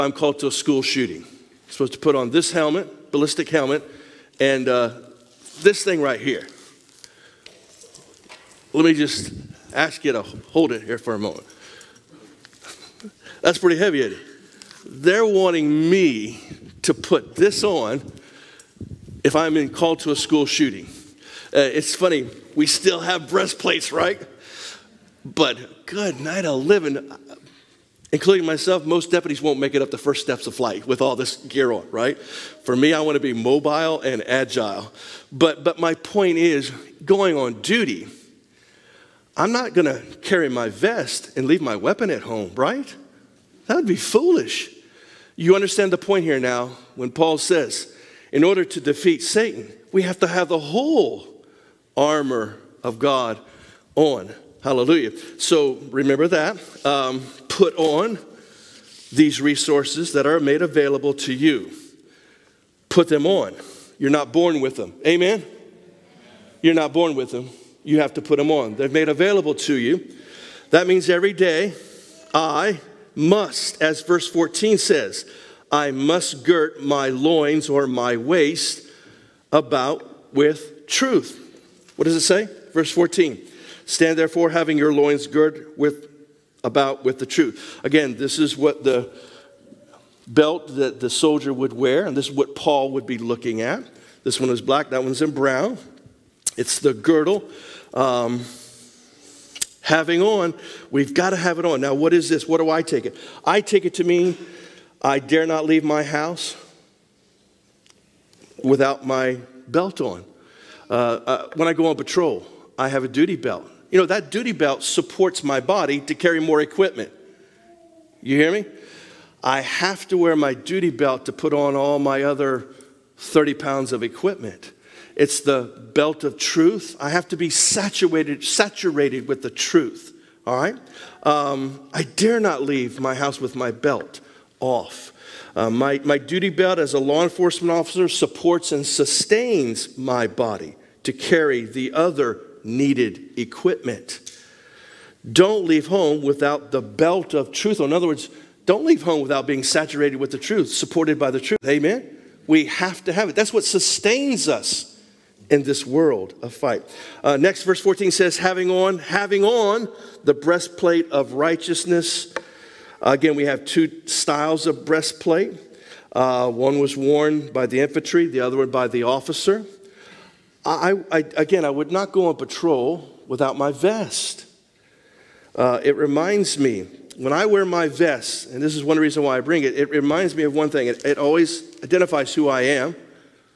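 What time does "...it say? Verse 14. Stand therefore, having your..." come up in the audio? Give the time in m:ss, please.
1:22.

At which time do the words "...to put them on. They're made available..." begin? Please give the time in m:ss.
1:08.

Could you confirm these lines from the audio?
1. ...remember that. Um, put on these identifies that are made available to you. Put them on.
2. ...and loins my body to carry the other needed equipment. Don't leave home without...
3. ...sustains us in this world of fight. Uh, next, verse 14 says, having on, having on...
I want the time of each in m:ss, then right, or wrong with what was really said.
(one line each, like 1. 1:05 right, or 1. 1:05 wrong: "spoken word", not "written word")
1. 0:55 wrong: "resources", not "identifies"
2. 2:18 wrong: "sustains", not "loins"
3. 2:33 right.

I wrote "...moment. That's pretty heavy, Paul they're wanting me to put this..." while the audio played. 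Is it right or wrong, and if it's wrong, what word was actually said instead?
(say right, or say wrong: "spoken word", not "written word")
wrong: "Eddie", not "Paul".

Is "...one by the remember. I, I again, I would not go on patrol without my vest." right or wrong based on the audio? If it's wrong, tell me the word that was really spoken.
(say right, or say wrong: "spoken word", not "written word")
wrong: "officer", not "remember".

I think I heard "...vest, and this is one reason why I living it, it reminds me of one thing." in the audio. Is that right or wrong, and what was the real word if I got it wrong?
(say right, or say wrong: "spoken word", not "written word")
wrong: "bring", not "living".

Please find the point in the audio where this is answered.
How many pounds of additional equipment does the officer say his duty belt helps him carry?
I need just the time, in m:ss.
2:03.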